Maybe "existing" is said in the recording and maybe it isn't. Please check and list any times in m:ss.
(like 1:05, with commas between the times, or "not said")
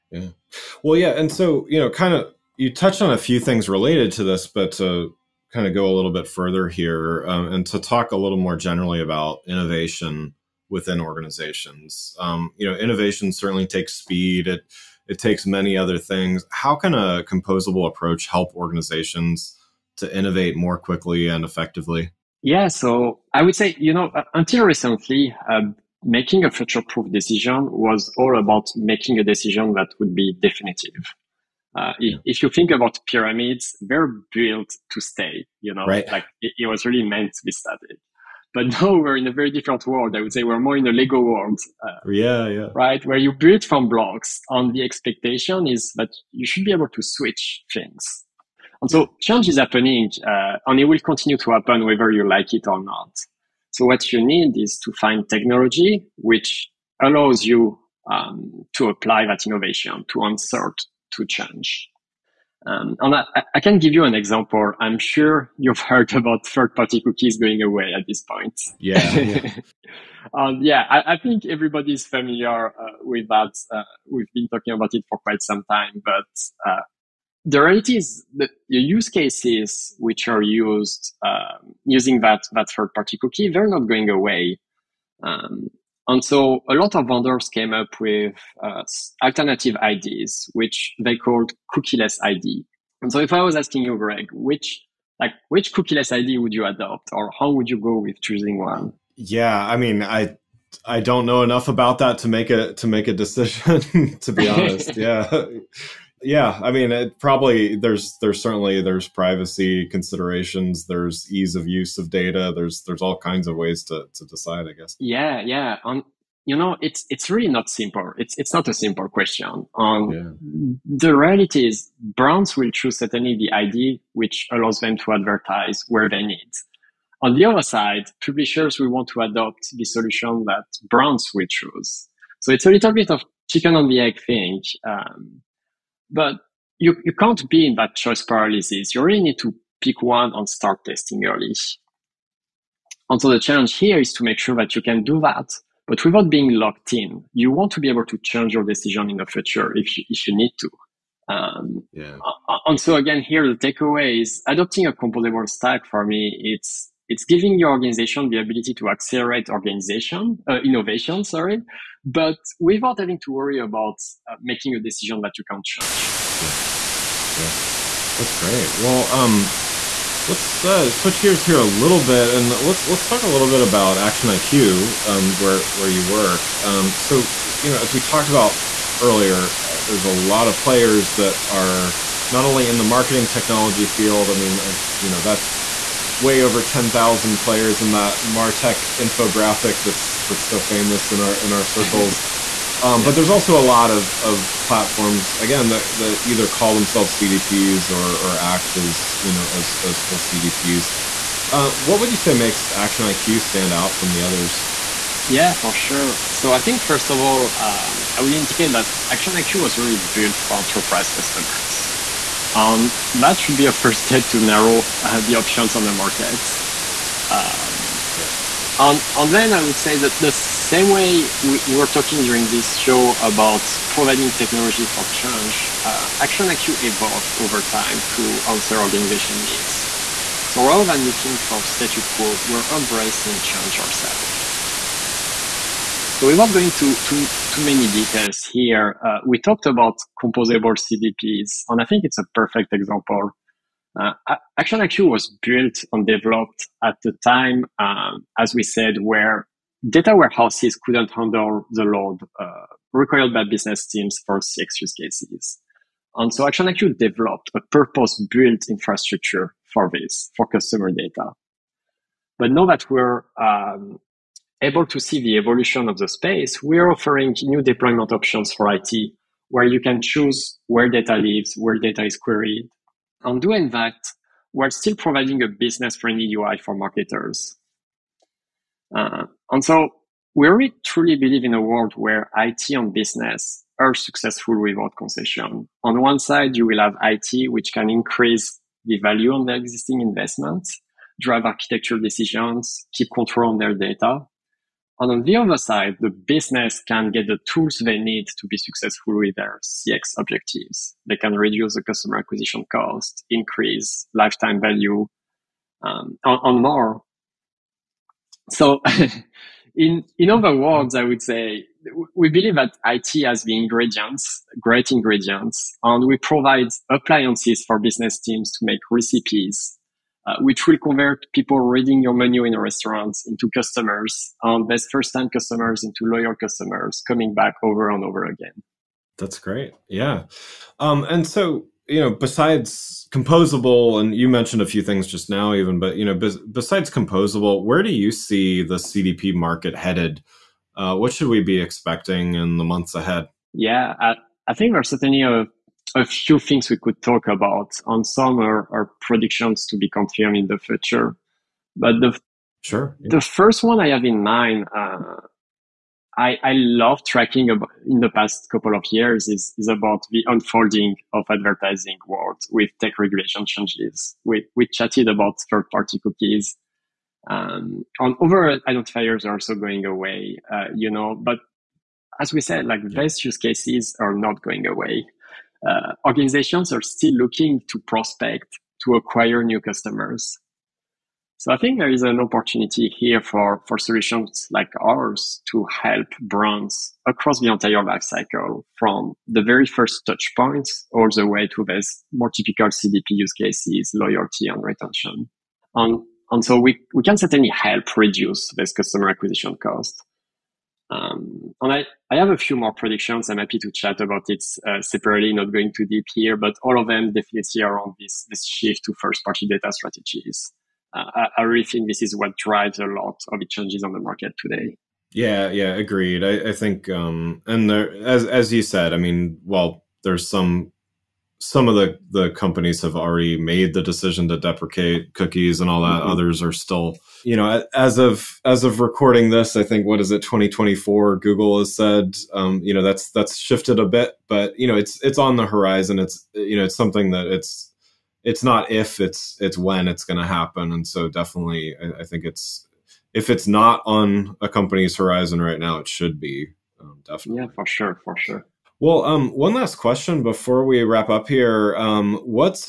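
4:49.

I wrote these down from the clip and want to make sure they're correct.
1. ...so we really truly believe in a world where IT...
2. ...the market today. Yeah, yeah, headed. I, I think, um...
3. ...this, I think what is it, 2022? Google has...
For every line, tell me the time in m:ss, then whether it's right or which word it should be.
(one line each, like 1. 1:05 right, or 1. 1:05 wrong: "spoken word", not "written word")
1. 4:39 right
2. 6:53 wrong: "agreed", not "headed"
3. 7:09 wrong: "2024", not "2022".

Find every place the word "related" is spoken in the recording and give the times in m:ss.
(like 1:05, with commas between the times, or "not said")
0:03.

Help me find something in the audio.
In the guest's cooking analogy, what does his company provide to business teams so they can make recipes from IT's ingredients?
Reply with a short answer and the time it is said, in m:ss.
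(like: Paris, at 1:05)
Appliances, at 5:16.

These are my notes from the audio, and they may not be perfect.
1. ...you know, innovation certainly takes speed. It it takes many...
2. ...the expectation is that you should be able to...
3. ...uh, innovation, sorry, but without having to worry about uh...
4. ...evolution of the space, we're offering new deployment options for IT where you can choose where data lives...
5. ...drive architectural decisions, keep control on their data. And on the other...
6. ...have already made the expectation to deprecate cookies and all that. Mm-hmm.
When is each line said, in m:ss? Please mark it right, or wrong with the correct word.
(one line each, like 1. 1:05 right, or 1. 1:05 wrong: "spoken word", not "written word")
1. 0:12 right
2. 0:44 right
3. 2:40 right
4. 4:25 right
5. 4:51 right
6. 7:02 wrong: "decision", not "expectation".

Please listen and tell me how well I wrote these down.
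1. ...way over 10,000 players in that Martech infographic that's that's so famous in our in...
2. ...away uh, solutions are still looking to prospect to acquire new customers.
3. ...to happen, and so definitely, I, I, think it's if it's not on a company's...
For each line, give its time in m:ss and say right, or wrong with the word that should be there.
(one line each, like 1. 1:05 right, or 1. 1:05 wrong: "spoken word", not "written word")
1. 3:06 right
2. 6:14 wrong: "organizations", not "solutions"
3. 7:20 right.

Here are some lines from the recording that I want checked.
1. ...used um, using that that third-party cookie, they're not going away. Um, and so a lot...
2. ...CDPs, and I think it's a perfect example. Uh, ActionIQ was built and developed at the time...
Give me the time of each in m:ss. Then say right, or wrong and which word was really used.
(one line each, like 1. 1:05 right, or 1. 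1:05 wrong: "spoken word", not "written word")
1. 1:20 right
2. 4:00 right.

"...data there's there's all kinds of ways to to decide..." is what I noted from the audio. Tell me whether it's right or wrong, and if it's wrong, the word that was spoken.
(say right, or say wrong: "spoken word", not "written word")
right.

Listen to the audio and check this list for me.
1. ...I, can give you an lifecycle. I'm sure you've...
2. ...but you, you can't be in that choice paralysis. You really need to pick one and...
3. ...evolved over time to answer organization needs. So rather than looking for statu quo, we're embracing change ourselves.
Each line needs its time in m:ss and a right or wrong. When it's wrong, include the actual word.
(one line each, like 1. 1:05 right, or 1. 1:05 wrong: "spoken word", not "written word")
1. 1:03 wrong: "example", not "lifecycle"
2. 2:16 right
3. 3:46 right.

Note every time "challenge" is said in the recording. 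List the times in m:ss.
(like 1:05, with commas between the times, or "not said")
2:23.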